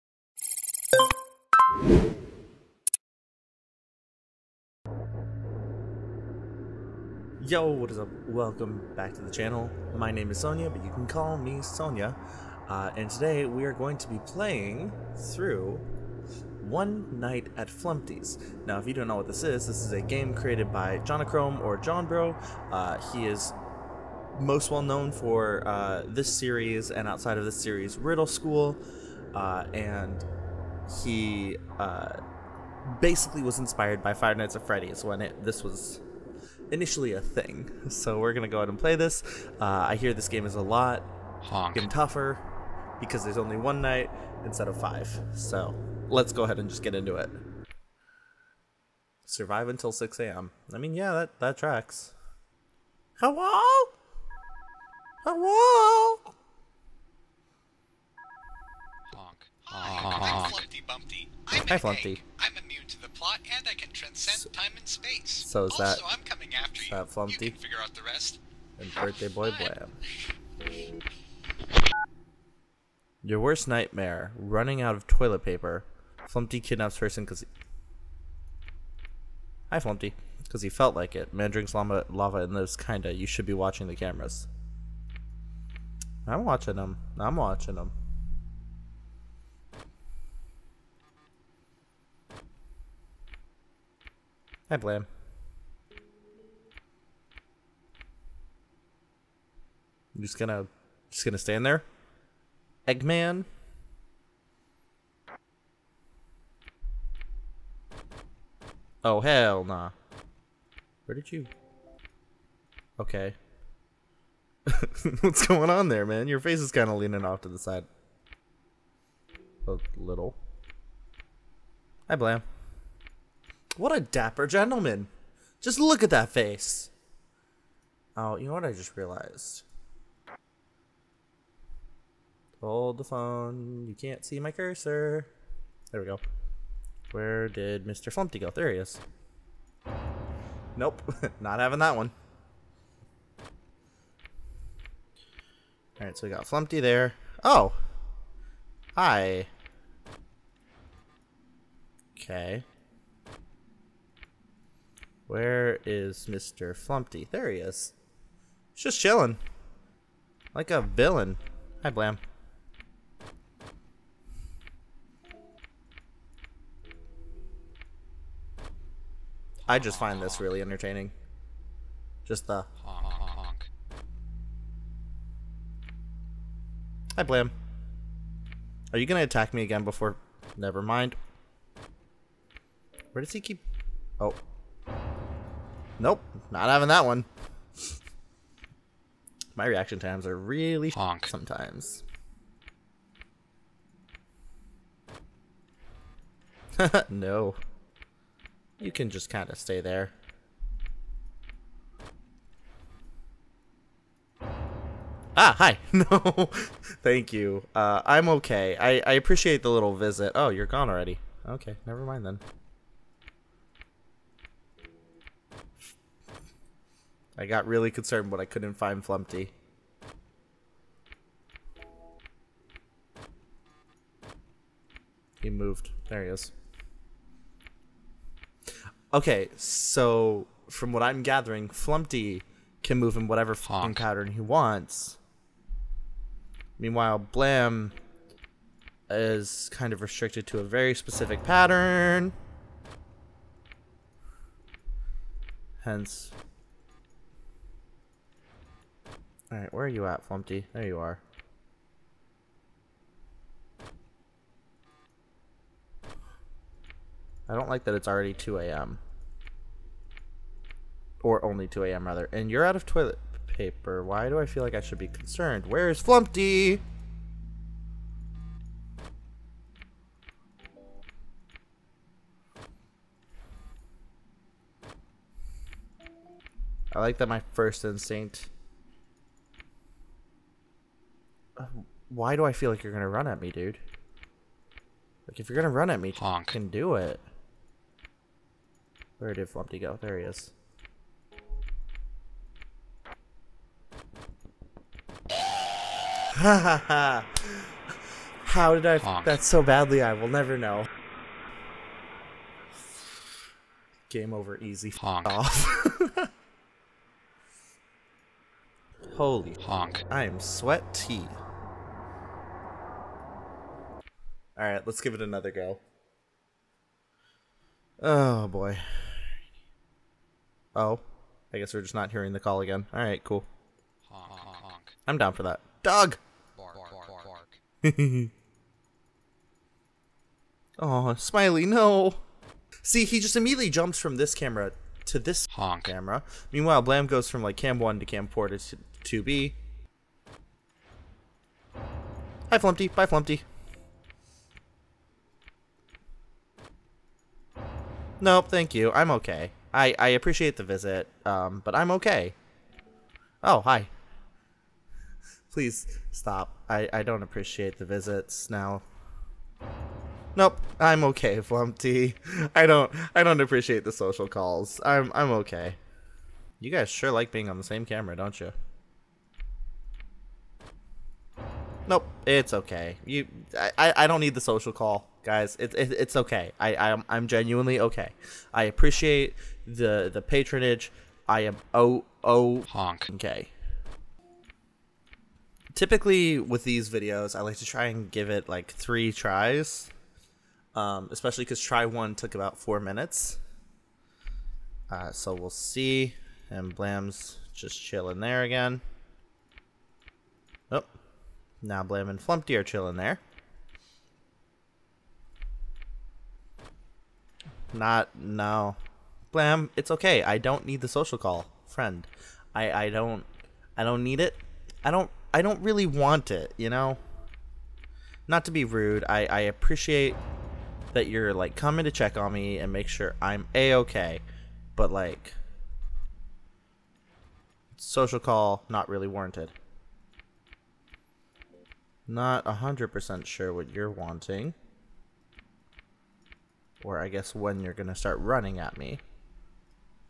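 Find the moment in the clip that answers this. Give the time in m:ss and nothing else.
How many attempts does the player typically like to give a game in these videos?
6:28.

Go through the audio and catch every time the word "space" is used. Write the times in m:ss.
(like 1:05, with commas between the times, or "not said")
1:04.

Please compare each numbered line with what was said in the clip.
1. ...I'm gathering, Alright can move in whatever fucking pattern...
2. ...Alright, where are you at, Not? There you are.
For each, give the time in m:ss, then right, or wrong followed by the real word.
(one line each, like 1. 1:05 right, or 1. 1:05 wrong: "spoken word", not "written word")
1. 3:51 wrong: "Flumpty", not "Alright"
2. 4:09 wrong: "Flumpty", not "Not".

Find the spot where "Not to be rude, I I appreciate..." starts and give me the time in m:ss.
6:58.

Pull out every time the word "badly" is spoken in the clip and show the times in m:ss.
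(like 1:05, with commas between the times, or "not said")
4:59.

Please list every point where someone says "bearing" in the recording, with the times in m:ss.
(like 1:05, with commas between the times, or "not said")
not said.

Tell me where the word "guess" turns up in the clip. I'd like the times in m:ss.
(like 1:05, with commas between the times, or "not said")
5:21, 7:17.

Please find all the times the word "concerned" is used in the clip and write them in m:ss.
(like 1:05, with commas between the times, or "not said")
3:37, 4:25.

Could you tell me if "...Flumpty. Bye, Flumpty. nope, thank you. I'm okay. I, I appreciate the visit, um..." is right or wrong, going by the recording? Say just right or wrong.
right.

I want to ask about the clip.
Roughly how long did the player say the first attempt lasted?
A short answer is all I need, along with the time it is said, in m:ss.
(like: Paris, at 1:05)
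4 minutes, at 6:32.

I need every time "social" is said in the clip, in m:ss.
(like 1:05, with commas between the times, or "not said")
6:03, 6:14, 6:50, 7:07.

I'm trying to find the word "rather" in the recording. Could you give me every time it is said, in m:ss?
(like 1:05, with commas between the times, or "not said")
4:22.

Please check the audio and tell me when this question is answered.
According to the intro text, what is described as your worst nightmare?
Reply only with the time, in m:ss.
1:14.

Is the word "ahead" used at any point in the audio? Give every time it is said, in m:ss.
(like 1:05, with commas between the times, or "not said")
0:38, 0:46.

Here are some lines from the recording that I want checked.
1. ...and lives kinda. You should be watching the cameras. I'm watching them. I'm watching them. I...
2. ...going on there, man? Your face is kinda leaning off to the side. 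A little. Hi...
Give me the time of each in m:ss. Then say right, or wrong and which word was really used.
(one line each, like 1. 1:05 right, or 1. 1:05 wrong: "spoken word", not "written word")
1. 1:22 right
2. 1:55 right.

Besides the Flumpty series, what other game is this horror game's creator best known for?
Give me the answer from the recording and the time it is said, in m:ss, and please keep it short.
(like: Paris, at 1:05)
Riddle School, at 0:27.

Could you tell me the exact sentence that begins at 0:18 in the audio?
Now, if you don't know what this is, this is a game created by Jonochrome or Johnbro.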